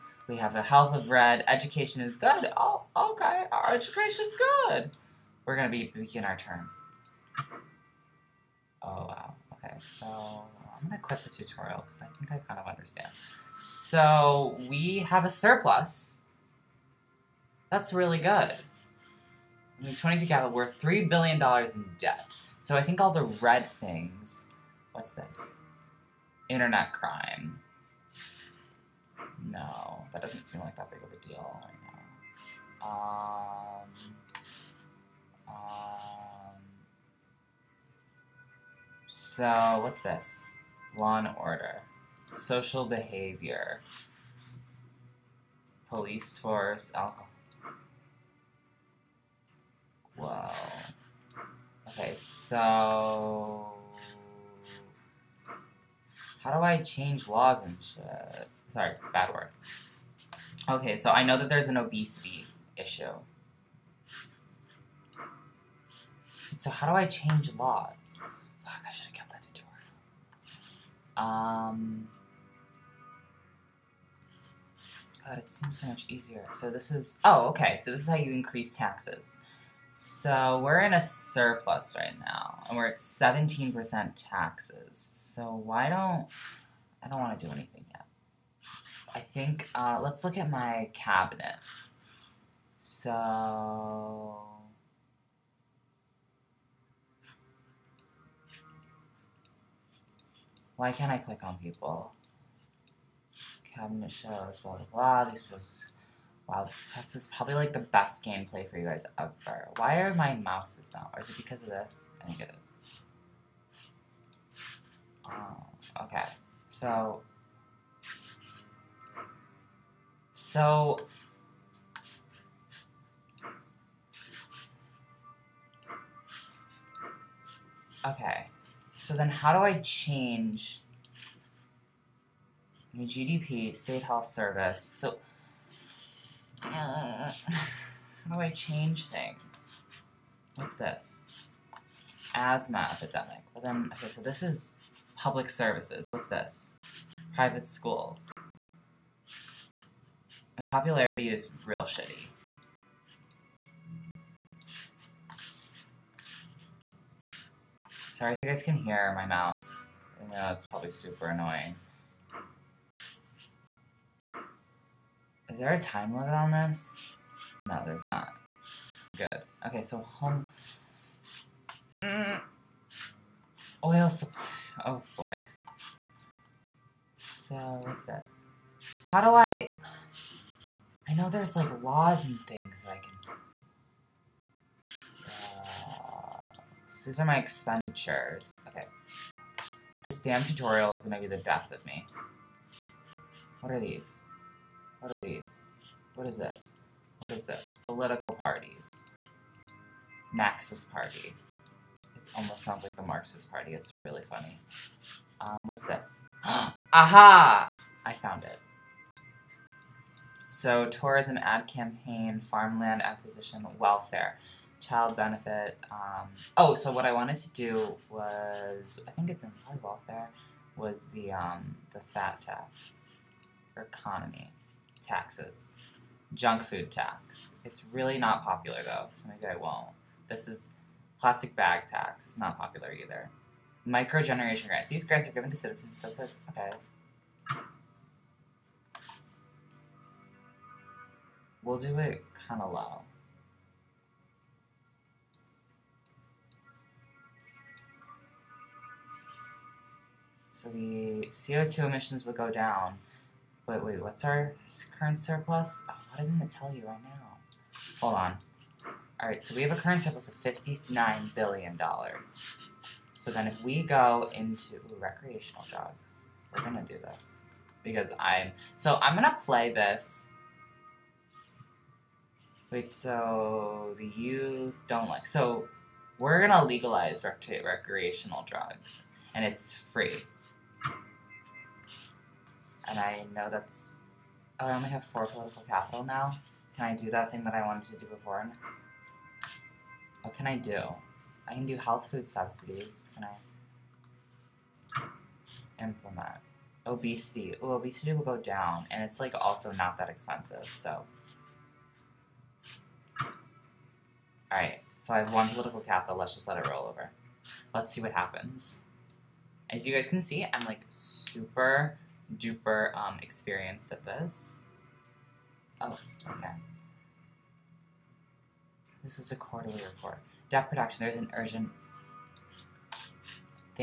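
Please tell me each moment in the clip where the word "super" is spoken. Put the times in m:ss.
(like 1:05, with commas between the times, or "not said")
2:40, 5:10.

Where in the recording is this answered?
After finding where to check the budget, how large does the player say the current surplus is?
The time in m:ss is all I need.
4:20.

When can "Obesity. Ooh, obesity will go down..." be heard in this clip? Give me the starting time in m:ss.
4:56.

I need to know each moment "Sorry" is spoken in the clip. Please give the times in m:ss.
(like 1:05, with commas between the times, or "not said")
0:58, 2:38.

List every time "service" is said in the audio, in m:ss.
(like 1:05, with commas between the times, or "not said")
2:14, 2:25.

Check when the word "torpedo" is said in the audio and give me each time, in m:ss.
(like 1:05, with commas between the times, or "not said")
not said.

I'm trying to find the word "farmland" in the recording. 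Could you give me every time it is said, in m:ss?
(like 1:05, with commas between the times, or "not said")
3:32.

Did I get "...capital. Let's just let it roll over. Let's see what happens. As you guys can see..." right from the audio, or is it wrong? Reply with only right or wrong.
right.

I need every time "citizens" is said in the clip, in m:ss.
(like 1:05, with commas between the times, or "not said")
3:55.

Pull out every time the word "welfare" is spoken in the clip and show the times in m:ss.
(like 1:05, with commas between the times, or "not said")
3:33, 3:39.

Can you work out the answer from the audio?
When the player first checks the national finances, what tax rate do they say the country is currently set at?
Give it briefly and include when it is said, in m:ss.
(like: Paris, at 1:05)
17%, at 1:22.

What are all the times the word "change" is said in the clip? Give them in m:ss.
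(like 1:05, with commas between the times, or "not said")
0:56, 1:07, 2:09, 2:18.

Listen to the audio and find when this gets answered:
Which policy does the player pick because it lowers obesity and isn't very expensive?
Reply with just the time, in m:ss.
4:51.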